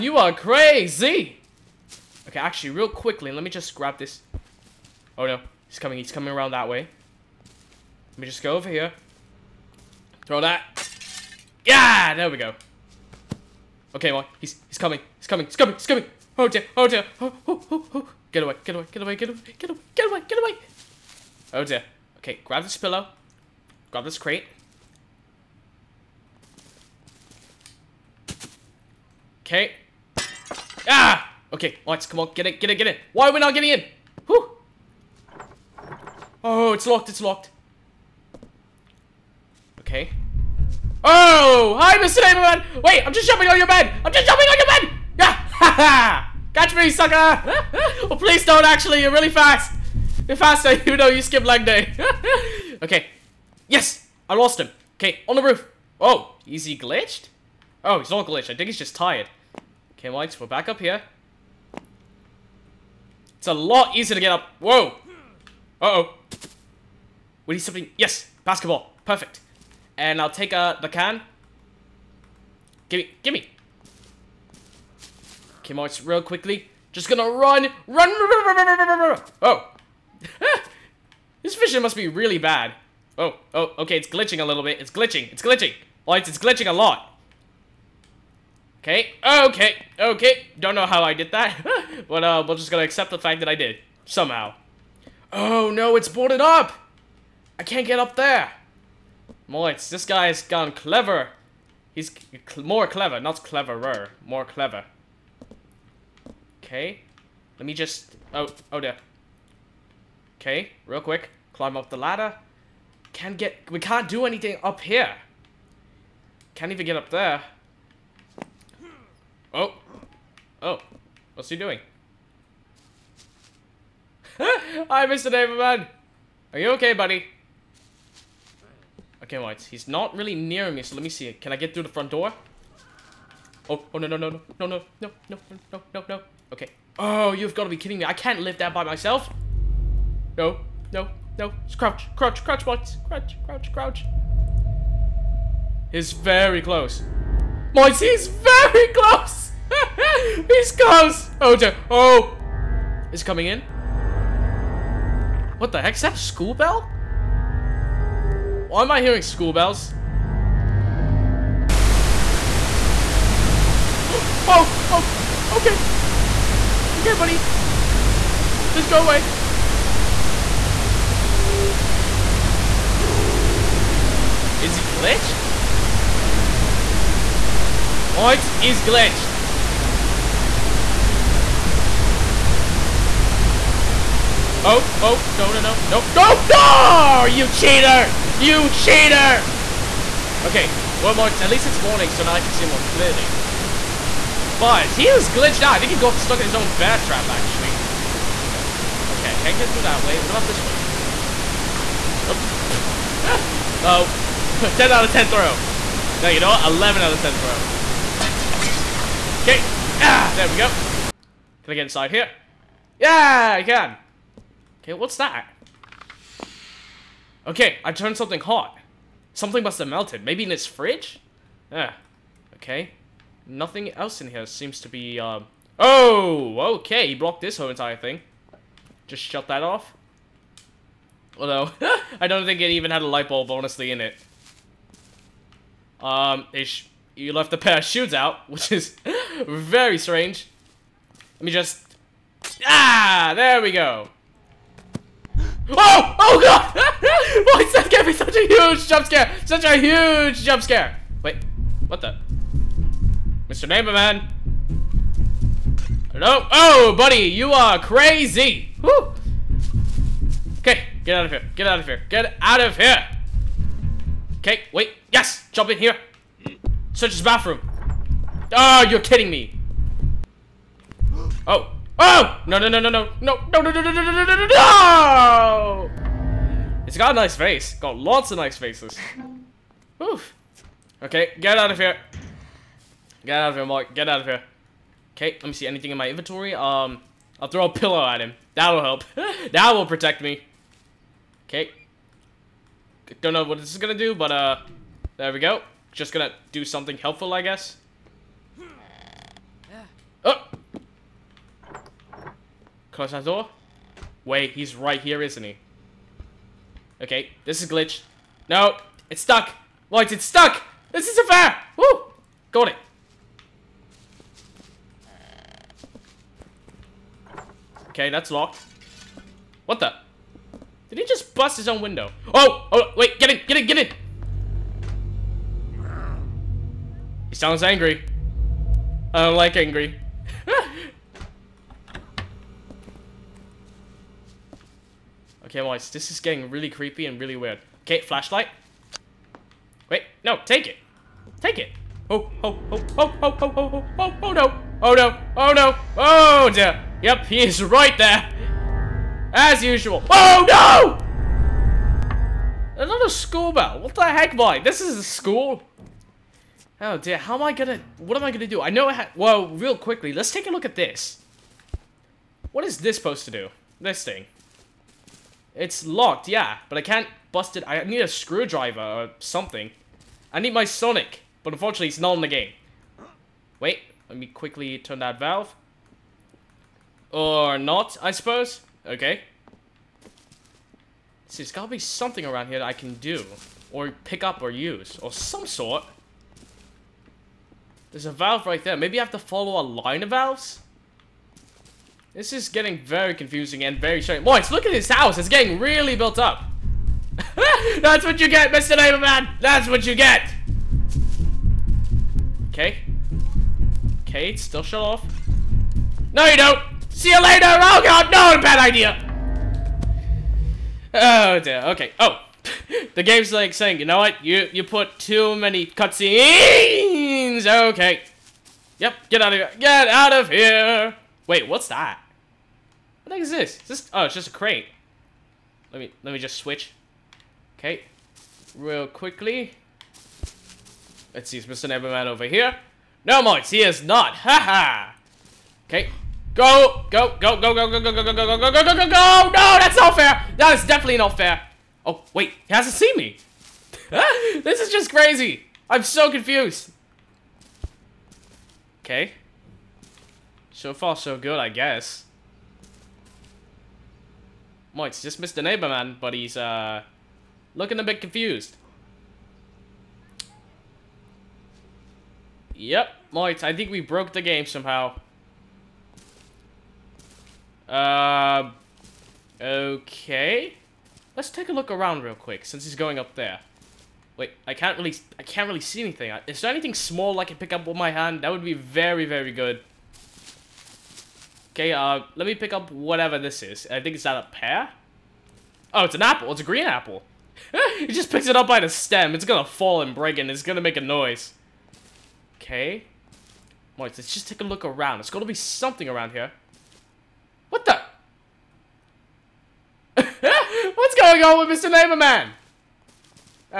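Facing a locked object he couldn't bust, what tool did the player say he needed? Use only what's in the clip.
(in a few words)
screwdriver.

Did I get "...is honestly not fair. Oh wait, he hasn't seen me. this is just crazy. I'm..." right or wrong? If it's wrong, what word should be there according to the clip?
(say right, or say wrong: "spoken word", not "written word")
wrong: "definitely", not "honestly".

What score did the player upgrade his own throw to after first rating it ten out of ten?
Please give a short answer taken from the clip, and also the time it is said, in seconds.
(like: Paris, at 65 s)
11 out of 10, at 206 s.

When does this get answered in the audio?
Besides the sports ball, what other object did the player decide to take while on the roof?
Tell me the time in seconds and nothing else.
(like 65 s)
70 s.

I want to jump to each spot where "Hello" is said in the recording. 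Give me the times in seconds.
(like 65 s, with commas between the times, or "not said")
256 s.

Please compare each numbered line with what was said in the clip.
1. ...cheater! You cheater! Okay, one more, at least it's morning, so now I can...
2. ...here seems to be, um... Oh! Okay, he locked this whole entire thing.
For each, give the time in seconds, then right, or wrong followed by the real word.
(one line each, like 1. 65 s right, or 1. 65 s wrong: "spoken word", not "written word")
1. 187 s right
2. 224 s wrong: "blocked", not "locked".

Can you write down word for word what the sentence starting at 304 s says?
Wait, he's right here, isn't he?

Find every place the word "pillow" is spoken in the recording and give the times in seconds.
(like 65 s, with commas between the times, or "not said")
22 s, 287 s.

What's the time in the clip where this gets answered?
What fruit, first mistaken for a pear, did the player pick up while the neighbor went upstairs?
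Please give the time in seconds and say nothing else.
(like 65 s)
486 s.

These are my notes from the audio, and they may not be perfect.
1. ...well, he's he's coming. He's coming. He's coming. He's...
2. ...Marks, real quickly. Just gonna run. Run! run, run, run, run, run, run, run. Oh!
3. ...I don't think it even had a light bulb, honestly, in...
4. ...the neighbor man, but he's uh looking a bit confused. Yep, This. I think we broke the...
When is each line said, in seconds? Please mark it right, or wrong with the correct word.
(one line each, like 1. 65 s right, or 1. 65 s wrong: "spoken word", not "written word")
1. 14 s right
2. 75 s right
3. 232 s right
4. 455 s wrong: "Moitz", not "This".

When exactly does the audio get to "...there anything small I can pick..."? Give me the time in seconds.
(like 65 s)
476 s.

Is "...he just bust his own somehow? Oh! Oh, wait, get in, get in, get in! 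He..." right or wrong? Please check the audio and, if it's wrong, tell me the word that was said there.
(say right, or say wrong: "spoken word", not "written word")
wrong: "window", not "somehow".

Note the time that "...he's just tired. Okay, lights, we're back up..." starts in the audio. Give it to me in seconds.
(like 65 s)
58 s.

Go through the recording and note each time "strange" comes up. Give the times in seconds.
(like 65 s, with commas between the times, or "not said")
239 s, 394 s.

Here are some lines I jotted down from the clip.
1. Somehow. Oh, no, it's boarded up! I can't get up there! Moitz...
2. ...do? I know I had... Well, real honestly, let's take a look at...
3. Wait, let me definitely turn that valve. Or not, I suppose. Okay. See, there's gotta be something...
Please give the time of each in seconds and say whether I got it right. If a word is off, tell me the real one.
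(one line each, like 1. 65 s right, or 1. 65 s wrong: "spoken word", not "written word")
1. 94 s right
2. 358 s wrong: "quickly", not "honestly"
3. 373 s wrong: "quickly", not "definitely".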